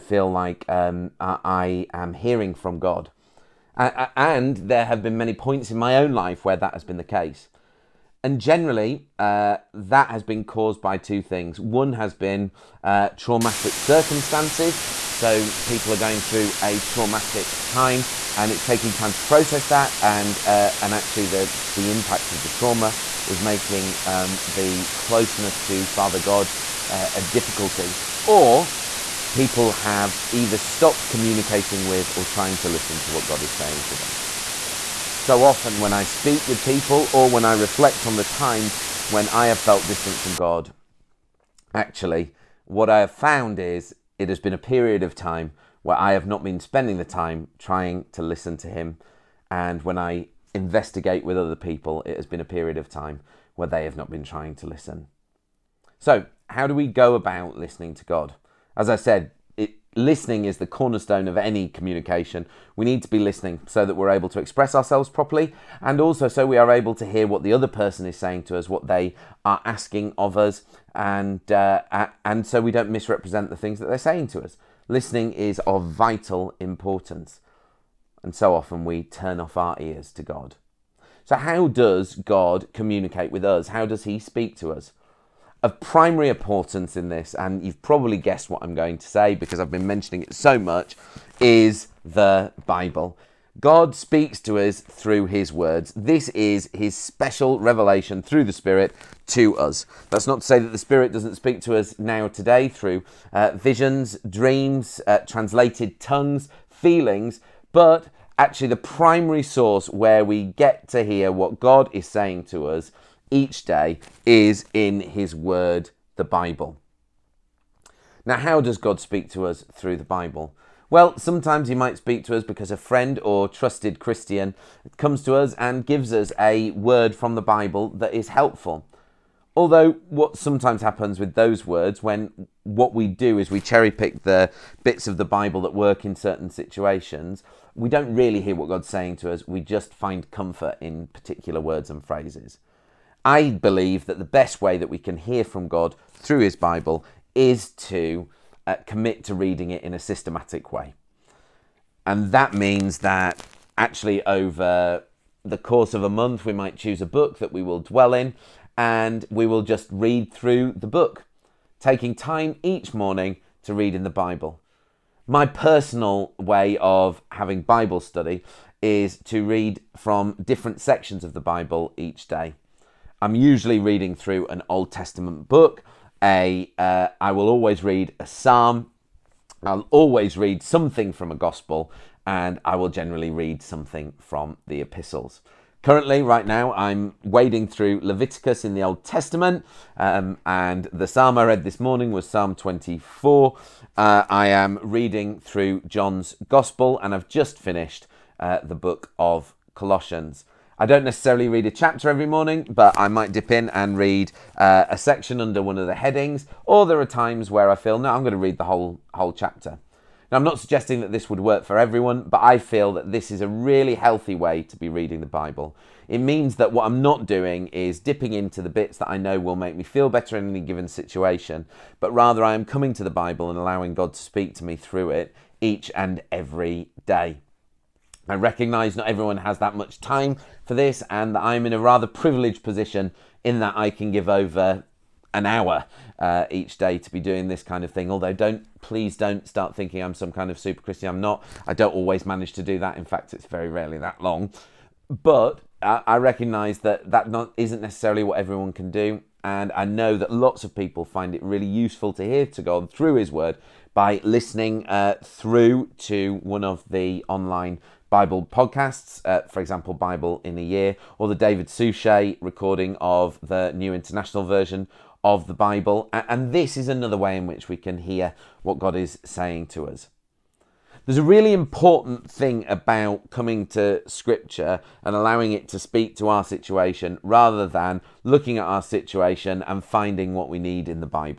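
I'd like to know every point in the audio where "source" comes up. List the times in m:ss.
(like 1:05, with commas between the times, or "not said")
1:49.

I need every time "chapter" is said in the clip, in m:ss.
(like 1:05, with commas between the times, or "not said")
3:21, 3:29.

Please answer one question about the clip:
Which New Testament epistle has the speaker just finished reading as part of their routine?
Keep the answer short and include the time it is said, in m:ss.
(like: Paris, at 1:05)
Colossians, at 3:19.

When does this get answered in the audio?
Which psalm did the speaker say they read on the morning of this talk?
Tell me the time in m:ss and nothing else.
3:12.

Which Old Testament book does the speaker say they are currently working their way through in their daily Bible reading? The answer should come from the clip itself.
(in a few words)
Leviticus.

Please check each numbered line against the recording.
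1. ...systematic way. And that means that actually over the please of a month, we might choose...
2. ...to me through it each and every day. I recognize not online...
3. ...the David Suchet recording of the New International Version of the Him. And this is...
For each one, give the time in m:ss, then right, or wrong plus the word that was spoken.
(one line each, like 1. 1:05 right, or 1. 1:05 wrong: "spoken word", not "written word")
1. 2:29 wrong: "course", not "please"
2. 3:44 wrong: "everyone", not "online"
3. 4:21 wrong: "Bible", not "Him".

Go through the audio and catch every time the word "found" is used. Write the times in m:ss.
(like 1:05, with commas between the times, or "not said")
0:43.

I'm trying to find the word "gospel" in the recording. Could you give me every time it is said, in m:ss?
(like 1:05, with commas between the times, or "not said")
3:01, 3:16.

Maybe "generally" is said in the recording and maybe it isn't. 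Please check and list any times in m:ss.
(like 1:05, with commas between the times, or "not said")
0:08, 3:02.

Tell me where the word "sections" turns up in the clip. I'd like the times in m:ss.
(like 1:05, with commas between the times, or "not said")
2:50, 3:24.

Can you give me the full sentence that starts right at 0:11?
One has been uh, traumatic circumstances.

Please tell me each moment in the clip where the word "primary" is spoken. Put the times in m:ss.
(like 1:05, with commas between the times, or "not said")
1:25, 1:48.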